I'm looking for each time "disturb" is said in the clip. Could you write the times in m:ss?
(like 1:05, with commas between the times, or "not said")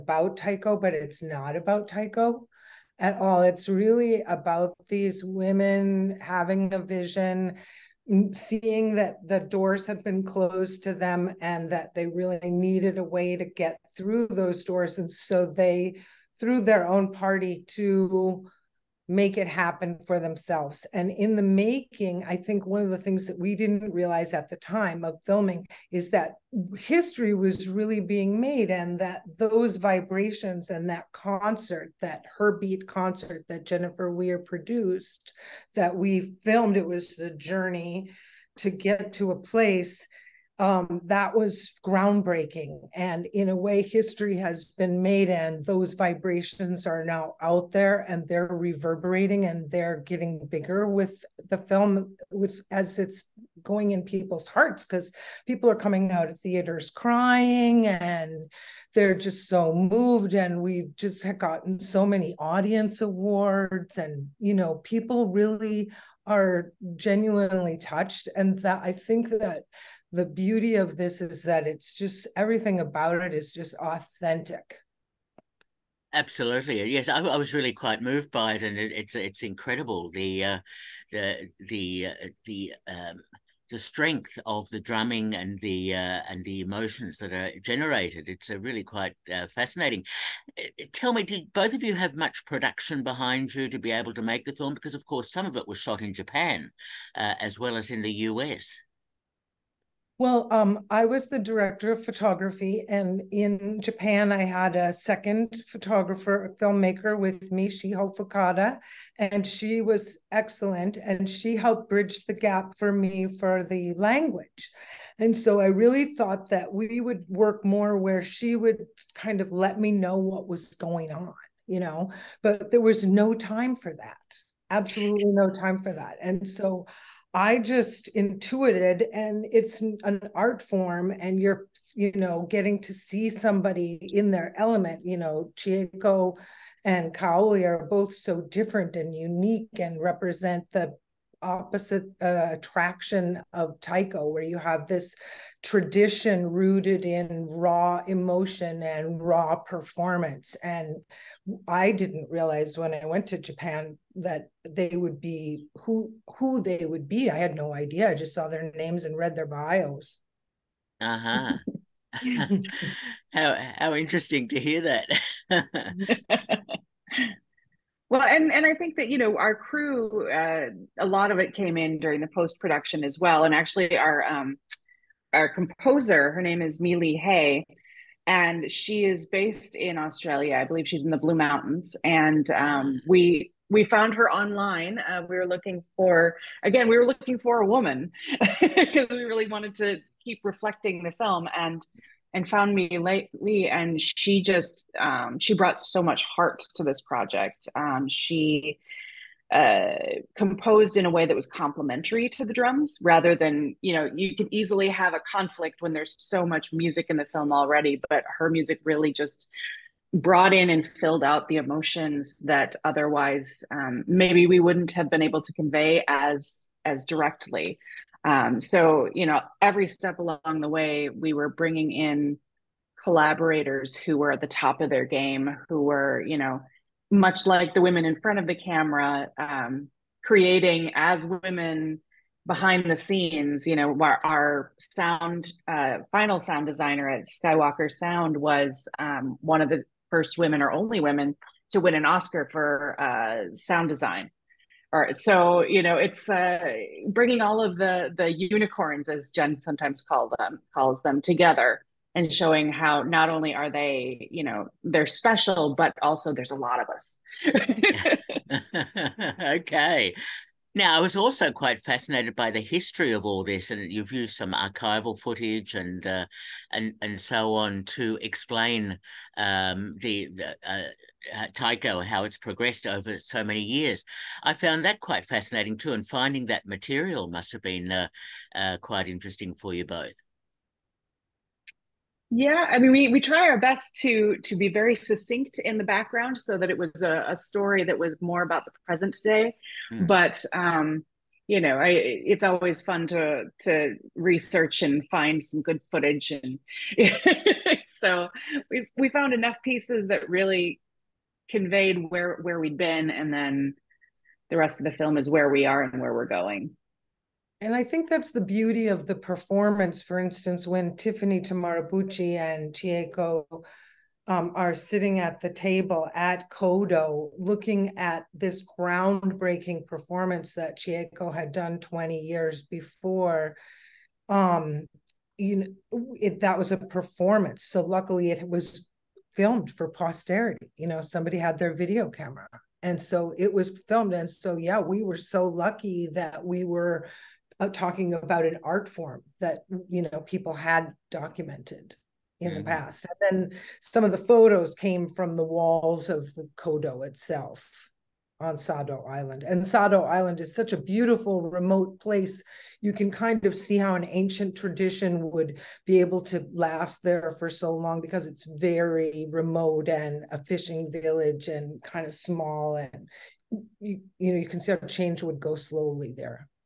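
not said.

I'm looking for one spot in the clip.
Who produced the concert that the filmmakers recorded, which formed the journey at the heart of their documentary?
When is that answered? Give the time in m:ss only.
0:33.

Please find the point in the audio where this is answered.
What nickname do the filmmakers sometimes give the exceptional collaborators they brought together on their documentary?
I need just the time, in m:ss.
4:08.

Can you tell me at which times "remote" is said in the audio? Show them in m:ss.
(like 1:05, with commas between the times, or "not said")
5:51, 5:59.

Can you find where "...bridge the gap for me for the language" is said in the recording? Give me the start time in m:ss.
1:51.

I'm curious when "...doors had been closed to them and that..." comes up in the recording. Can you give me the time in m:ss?
0:09.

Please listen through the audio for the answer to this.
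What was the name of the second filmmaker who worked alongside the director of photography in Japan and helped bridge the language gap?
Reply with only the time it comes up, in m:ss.
1:47.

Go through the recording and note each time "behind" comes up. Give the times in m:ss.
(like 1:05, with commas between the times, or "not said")
1:33, 3:52.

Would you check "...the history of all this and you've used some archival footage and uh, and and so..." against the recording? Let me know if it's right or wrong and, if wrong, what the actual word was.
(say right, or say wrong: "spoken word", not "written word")
right.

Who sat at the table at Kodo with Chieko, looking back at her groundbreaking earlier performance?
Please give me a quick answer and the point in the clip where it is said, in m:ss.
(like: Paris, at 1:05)
Tiffany Tamaribuchi, at 5:10.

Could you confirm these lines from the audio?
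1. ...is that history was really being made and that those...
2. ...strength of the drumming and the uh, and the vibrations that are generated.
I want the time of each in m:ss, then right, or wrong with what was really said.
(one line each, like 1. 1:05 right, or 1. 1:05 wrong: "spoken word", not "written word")
1. 0:25 right
2. 1:23 wrong: "emotions", not "vibrations".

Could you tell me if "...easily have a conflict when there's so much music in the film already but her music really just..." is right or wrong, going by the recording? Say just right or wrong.
right.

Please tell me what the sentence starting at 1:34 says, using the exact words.
Because of course, some of it was shot in Japan, uh, as well as in the US.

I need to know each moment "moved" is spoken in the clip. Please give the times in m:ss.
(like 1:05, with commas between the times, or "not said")
0:59, 1:18.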